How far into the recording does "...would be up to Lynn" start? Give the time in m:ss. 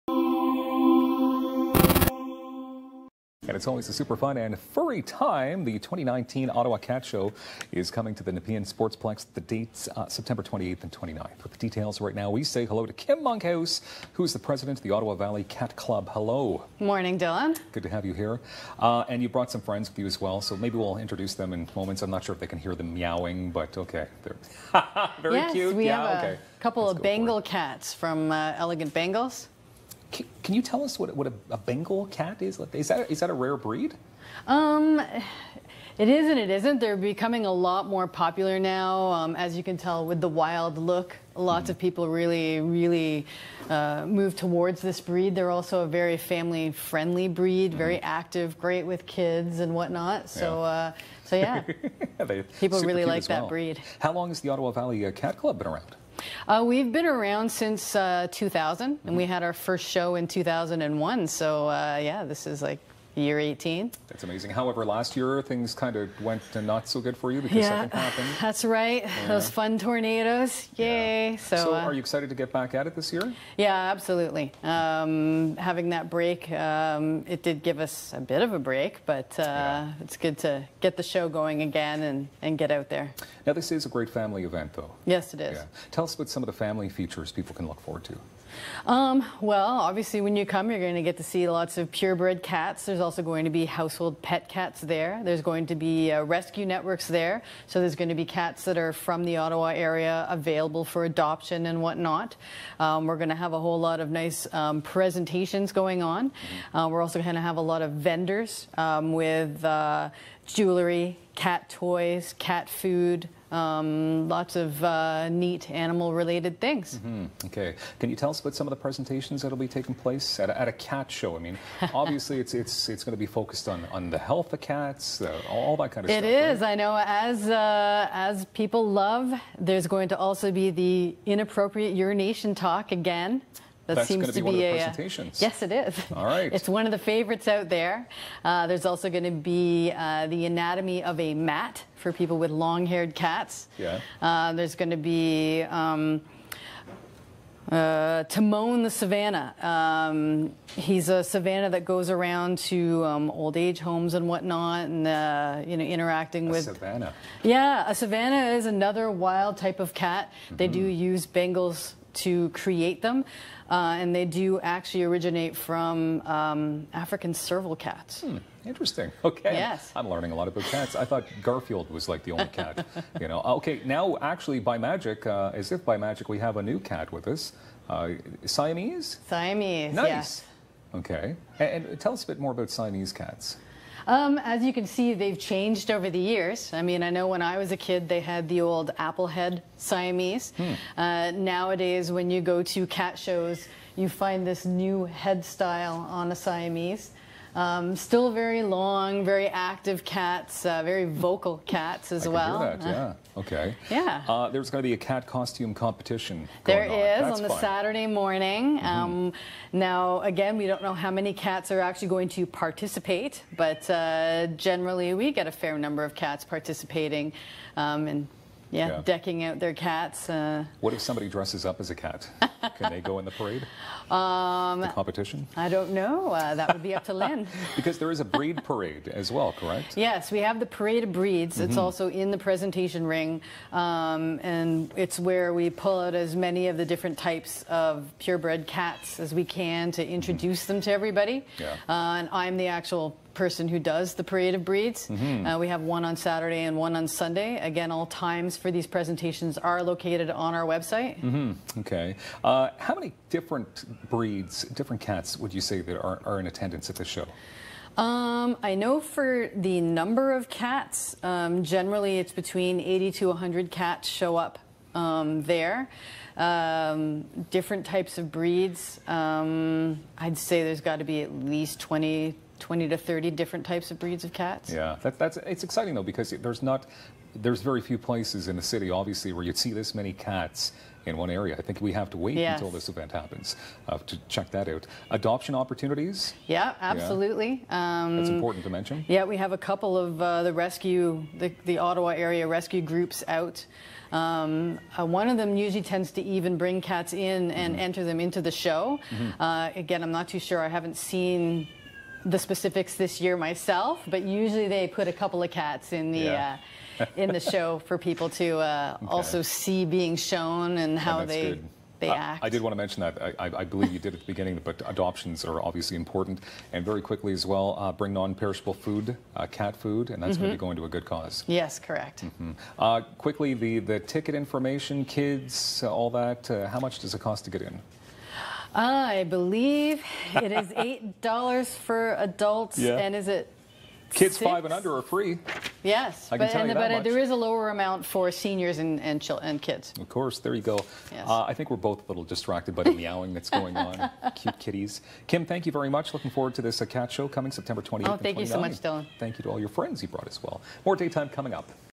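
3:46.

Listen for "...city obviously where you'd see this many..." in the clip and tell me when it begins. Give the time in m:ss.
4:38.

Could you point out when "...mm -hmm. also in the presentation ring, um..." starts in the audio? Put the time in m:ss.
3:51.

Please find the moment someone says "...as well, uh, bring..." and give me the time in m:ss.
5:17.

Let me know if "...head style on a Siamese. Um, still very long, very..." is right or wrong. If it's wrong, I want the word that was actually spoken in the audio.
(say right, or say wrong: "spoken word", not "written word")
right.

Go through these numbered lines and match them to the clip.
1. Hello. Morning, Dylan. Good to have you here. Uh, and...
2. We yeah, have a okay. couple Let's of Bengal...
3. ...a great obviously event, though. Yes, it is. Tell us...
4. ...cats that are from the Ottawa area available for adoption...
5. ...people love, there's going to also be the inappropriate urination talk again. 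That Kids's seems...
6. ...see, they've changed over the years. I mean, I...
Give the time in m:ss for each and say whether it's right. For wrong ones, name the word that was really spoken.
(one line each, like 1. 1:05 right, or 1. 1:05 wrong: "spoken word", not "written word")
1. 0:16 right
2. 0:25 right
3. 1:23 wrong: "family", not "obviously"
4. 1:38 right
5. 2:08 wrong: "That", not "Kids"
6. 3:04 right.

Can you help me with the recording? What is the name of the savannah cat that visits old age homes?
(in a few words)
Timon.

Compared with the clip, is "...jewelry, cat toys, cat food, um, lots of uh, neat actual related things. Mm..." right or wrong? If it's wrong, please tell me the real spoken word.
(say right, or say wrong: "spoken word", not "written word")
wrong: "animal", not "actual".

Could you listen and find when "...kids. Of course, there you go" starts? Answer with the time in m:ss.
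5:39.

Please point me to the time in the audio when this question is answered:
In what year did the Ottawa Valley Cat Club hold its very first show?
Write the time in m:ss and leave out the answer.
1:00.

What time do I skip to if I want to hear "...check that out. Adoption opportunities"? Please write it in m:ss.
4:44.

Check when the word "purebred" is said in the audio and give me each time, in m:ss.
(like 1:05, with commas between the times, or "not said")
1:31, 3:58.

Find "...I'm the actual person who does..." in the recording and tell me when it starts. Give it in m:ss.
4:02.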